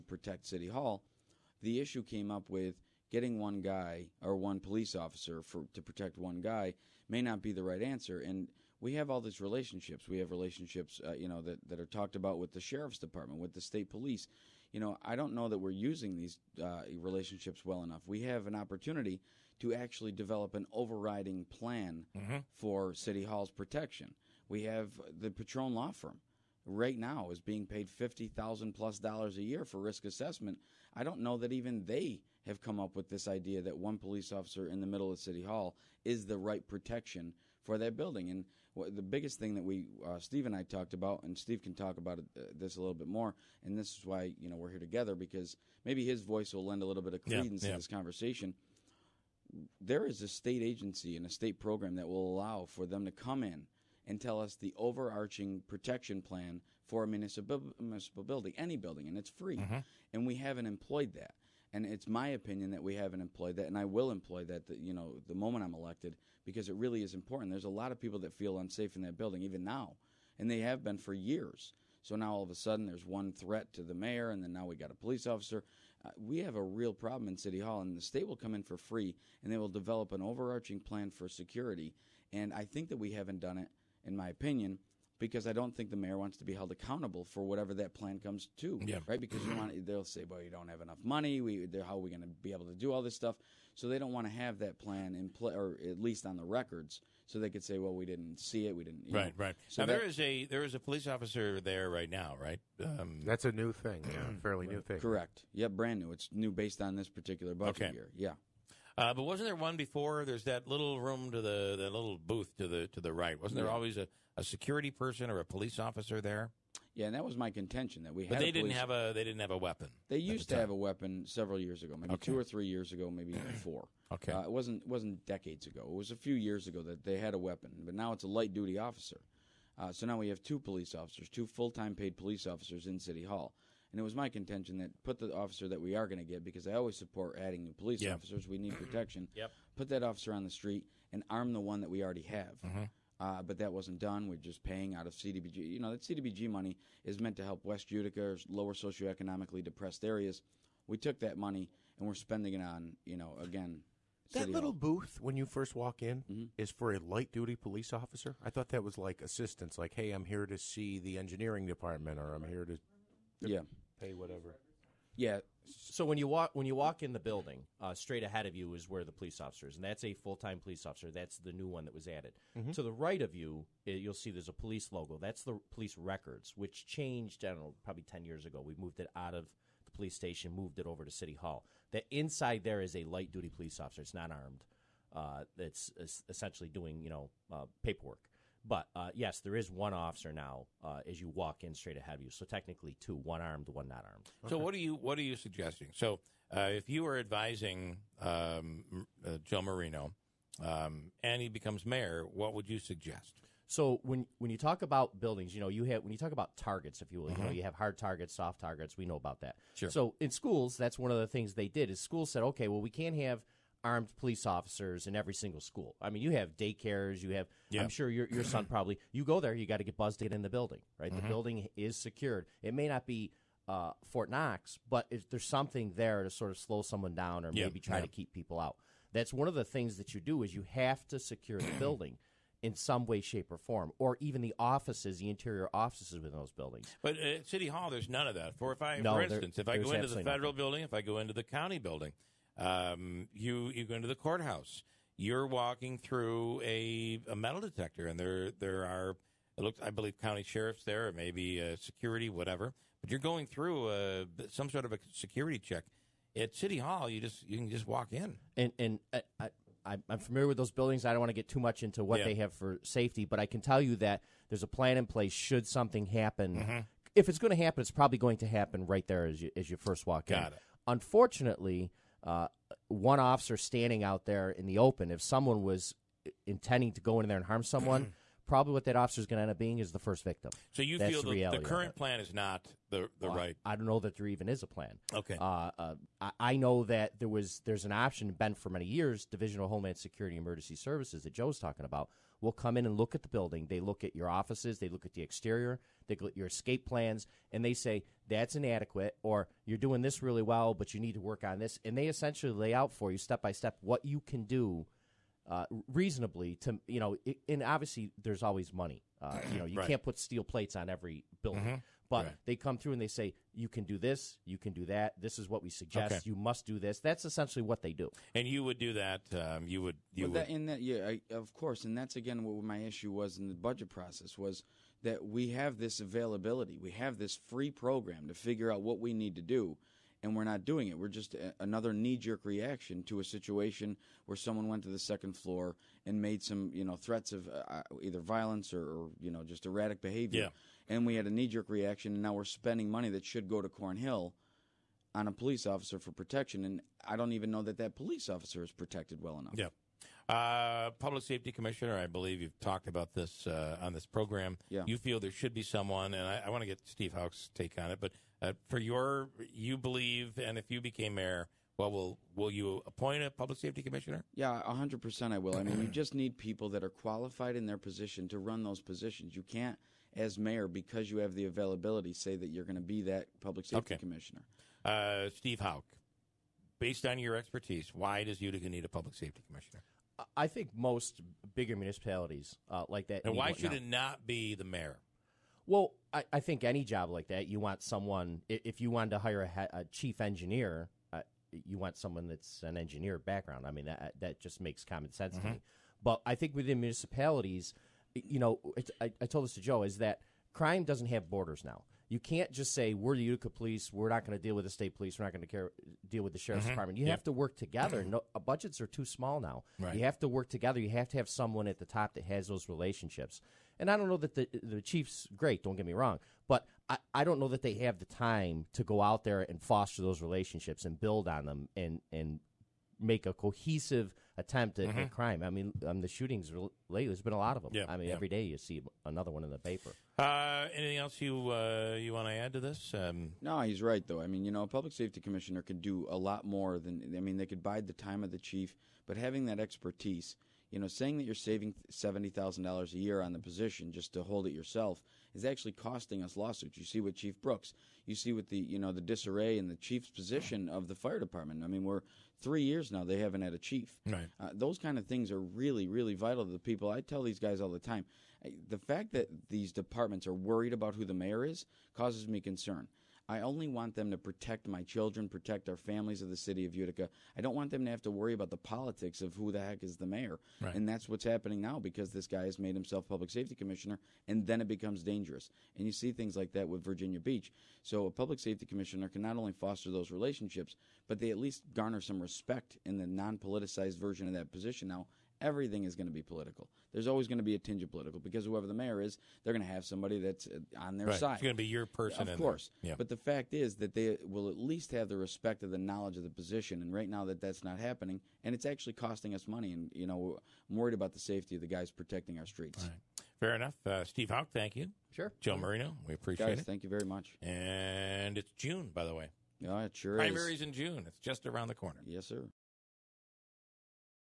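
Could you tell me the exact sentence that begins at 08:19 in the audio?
And you know, I'm worried about the safety of the guys protecting our streets.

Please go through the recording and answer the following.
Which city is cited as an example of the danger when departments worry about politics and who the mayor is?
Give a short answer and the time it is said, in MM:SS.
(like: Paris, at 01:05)
Virginia Beach, at 07:56.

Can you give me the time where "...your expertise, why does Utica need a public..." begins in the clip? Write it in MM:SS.
06:17.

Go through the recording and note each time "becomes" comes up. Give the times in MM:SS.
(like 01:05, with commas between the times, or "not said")
03:21, 07:54.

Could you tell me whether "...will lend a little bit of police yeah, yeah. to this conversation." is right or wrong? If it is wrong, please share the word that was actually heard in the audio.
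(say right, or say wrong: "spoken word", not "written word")
wrong: "credence", not "police".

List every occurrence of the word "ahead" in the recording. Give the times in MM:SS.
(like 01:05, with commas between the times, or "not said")
02:48, 03:11.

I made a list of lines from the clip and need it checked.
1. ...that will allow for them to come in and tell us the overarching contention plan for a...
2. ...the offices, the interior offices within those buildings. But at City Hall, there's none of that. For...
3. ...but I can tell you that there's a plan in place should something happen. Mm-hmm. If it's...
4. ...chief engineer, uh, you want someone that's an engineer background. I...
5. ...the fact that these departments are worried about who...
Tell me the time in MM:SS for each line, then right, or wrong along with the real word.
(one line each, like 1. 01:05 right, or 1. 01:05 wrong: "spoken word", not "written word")
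1. 00:51 wrong: "protection", not "contention"
2. 03:54 right
3. 04:23 right
4. 06:29 right
5. 07:38 right.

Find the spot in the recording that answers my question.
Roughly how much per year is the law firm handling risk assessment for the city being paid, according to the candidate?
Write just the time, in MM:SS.
00:27.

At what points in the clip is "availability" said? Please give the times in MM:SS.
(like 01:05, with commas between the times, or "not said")
05:25, 06:11.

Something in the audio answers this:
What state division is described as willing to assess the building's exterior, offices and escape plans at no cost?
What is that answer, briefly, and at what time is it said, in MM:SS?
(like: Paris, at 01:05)
Division of Homeland Security Emergency Services, at 04:49.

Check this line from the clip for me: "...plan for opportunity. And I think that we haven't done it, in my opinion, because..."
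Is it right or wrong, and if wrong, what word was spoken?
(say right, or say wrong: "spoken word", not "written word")
wrong: "security", not "opportunity".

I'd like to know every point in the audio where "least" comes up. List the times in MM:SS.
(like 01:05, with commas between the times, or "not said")
01:35, 08:01, 08:14.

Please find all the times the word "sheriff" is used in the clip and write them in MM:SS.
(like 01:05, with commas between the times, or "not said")
00:12, 04:10, 06:46.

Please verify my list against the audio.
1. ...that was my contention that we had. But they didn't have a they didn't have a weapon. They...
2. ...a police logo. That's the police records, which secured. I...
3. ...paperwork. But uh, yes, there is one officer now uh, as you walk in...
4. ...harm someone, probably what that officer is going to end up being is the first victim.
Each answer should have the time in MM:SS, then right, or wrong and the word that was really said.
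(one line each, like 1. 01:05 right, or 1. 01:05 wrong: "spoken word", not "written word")
1. 01:57 right
2. 02:54 wrong: "changed", not "secured"
3. 03:07 right
4. 04:37 right.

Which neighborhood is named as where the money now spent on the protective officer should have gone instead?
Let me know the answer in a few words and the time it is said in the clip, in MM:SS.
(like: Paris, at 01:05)
Cornhill, at 05:43.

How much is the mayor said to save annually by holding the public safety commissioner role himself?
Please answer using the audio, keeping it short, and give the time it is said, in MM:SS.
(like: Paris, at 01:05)
$70,000, at 07:21.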